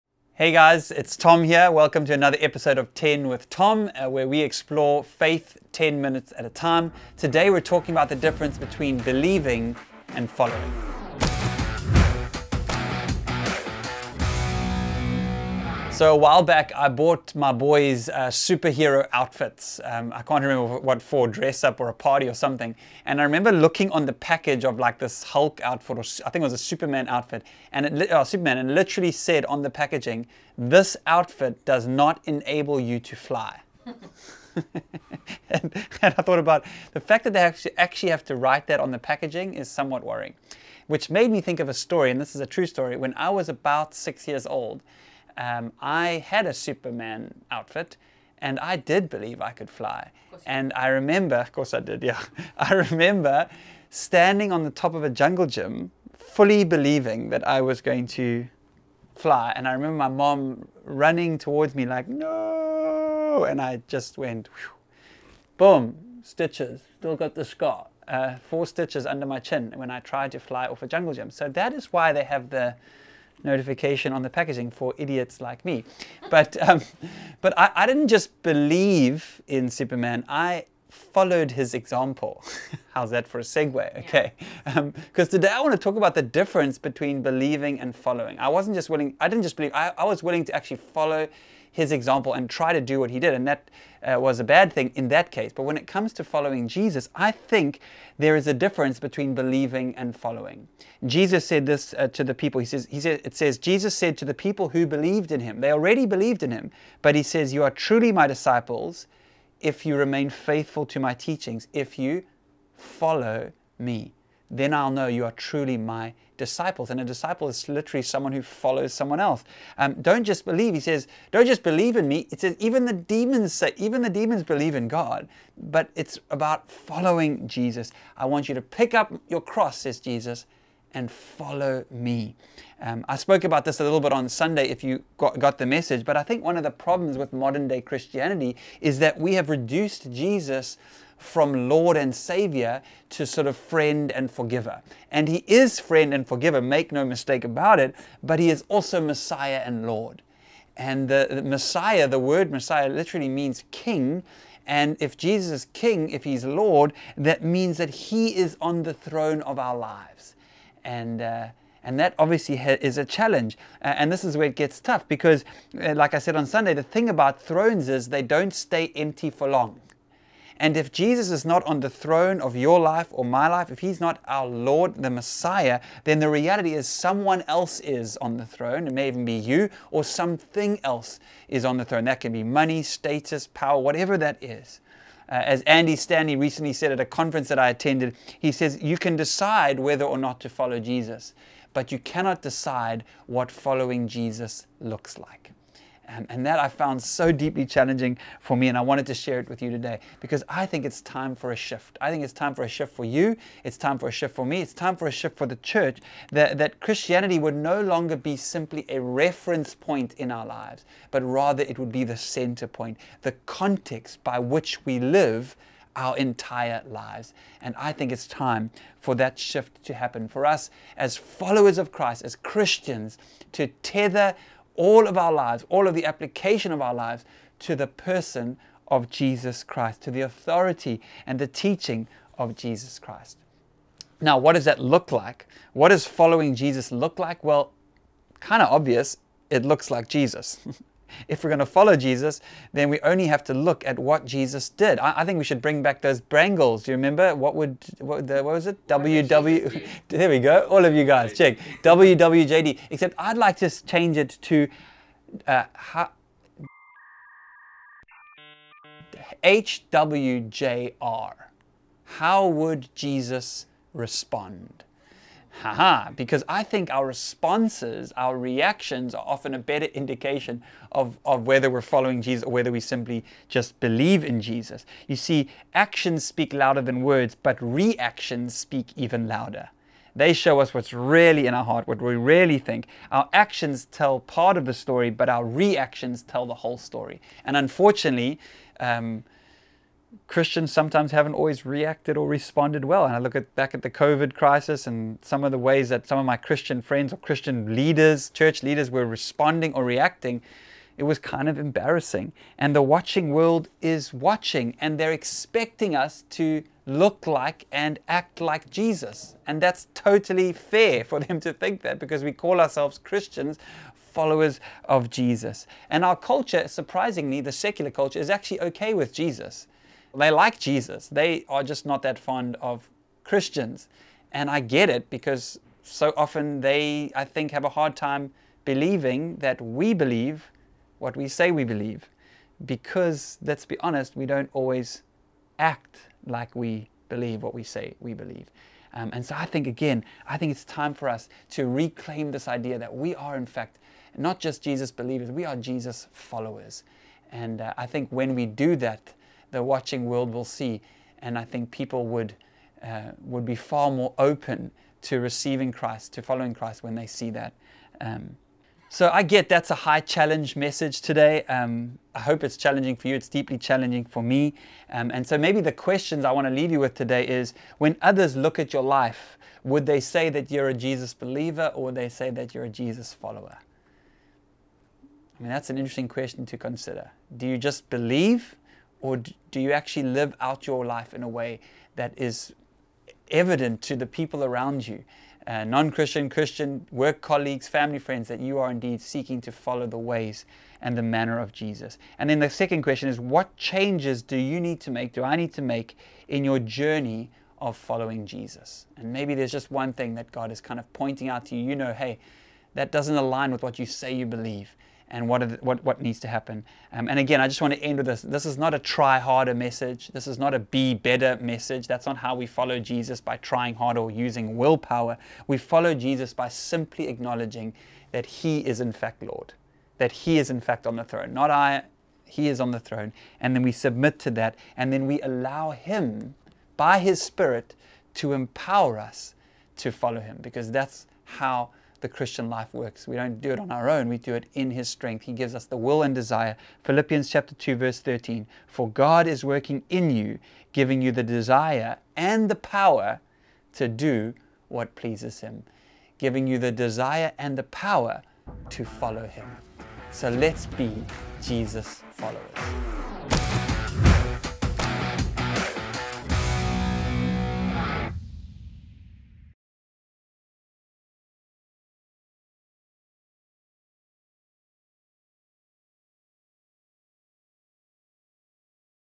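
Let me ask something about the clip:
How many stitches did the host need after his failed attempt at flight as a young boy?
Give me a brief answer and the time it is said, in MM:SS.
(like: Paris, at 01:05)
4, at 01:08.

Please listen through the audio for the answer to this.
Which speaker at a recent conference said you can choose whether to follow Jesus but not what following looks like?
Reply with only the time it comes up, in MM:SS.
03:05.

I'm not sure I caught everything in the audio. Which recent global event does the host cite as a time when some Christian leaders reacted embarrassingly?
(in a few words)
COVID crisis.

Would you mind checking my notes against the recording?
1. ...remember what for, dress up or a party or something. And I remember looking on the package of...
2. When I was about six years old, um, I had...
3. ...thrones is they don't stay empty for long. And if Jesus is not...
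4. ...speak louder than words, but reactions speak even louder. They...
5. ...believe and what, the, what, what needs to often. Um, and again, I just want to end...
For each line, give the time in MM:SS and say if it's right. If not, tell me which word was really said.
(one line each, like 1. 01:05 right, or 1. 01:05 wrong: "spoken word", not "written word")
1. 00:20 right
2. 00:42 right
3. 02:47 right
4. 04:36 right
5. 06:44 wrong: "happen", not "often".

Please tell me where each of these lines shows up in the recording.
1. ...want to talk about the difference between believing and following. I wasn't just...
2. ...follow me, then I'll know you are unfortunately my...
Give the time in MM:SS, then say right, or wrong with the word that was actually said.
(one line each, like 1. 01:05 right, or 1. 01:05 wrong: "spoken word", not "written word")
1. 01:25 right
2. 01:52 wrong: "truly", not "unfortunately".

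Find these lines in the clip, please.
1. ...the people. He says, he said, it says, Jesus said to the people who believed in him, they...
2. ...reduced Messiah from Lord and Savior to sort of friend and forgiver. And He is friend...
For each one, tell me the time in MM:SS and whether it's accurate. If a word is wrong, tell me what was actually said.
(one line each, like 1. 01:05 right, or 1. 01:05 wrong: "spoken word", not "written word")
1. 01:42 right
2. 02:19 wrong: "Jesus", not "Messiah".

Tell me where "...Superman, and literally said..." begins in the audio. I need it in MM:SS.
00:28.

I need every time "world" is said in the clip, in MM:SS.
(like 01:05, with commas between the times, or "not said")
05:03, 05:50.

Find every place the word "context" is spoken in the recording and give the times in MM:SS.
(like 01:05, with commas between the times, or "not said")
03:33.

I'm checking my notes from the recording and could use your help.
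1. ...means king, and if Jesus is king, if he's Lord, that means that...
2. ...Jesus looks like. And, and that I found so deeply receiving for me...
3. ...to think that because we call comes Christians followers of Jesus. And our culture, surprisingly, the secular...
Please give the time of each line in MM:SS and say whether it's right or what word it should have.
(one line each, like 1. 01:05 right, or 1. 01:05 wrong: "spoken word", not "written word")
1. 02:33 right
2. 03:14 wrong: "challenging", not "receiving"
3. 05:11 wrong: "ourselves", not "comes".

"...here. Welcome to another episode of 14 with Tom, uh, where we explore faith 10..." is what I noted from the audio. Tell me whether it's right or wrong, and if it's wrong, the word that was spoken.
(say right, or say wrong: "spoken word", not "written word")
wrong: "10", not "14".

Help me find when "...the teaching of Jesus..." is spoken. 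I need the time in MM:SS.
03:51.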